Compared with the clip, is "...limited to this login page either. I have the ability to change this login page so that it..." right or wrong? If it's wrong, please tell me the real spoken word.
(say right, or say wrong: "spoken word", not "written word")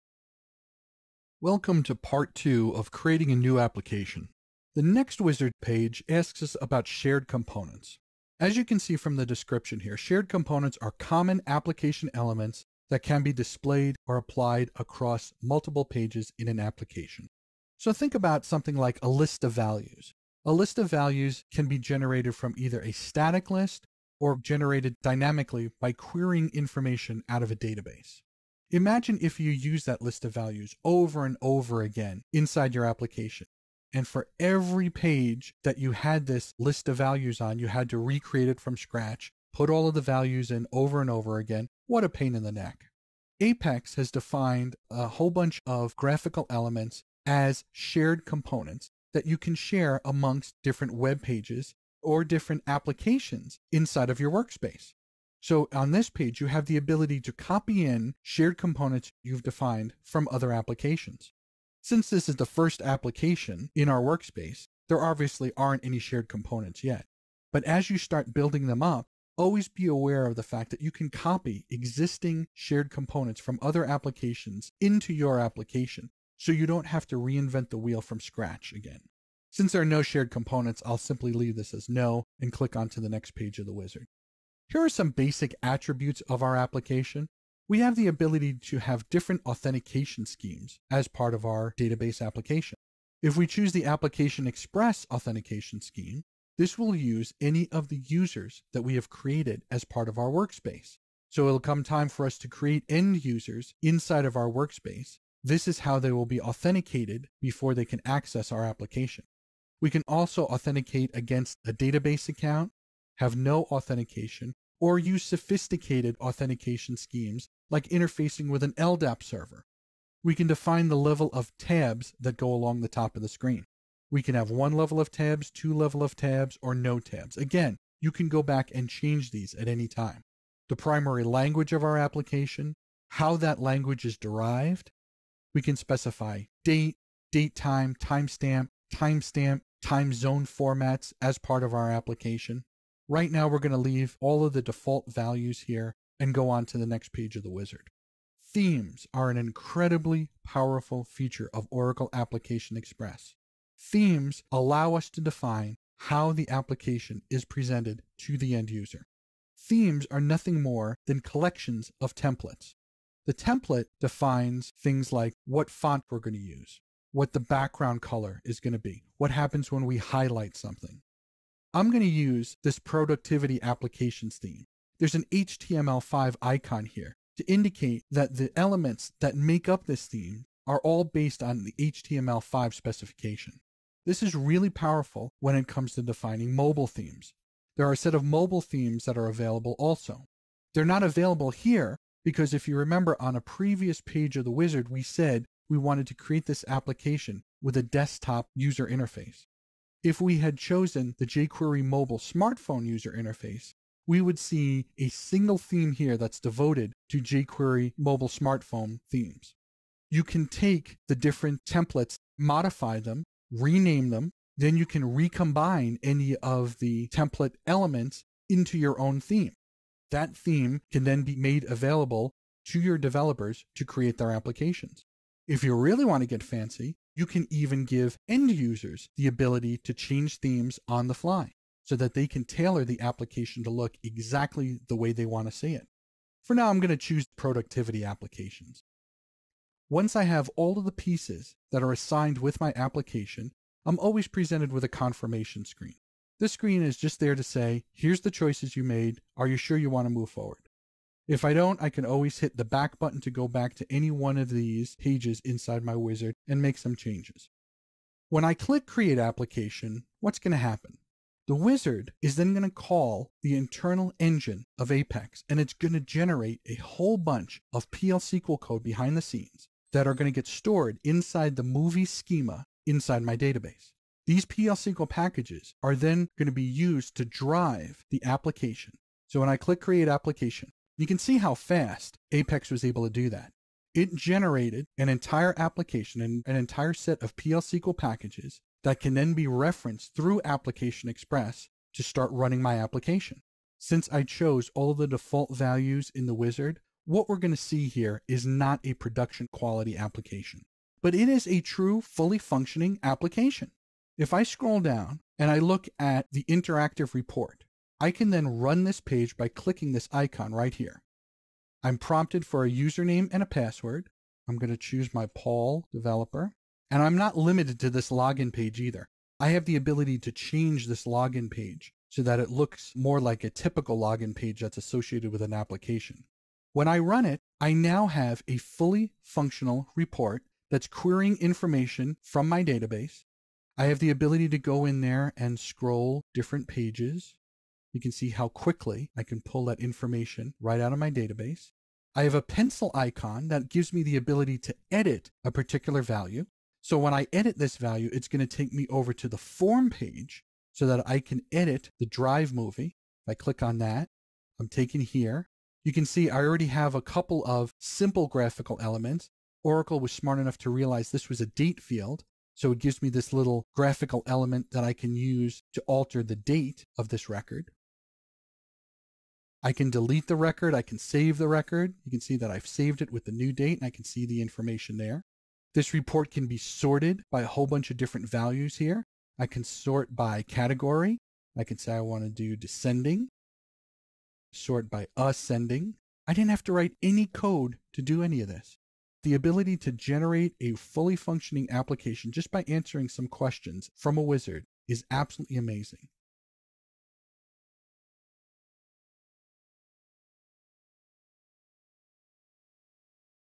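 right.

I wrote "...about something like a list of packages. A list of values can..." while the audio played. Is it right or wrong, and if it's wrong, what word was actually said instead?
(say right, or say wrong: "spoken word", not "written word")
wrong: "values", not "packages".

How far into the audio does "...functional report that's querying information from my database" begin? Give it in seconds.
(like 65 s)
329 s.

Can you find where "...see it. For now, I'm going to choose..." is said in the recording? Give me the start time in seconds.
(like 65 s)
235 s.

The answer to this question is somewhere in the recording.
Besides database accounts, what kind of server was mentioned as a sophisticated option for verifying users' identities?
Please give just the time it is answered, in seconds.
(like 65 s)
118 s.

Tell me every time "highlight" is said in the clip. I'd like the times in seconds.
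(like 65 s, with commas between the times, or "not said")
169 s.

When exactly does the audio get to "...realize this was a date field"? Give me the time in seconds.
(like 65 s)
360 s.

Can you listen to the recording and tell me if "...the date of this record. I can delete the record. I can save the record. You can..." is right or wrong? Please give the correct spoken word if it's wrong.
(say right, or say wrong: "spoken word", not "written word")
right.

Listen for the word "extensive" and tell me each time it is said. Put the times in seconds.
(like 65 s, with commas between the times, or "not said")
not said.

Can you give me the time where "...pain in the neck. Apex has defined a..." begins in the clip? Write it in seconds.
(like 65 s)
42 s.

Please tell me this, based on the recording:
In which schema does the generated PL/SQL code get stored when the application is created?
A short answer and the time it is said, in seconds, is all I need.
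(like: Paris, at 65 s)
movie schema, at 271 s.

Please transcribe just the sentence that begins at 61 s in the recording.
Since this is the first application in our workspace, there obviously aren't any shared components yet.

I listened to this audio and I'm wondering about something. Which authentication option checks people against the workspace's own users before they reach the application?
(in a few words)
Application Express authentication.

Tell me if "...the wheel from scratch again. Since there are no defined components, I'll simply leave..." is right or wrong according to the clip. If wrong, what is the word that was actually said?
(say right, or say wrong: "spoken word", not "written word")
wrong: "shared", not "defined".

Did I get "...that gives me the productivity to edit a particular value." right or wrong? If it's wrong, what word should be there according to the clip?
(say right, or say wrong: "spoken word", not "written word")
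wrong: "ability", not "productivity".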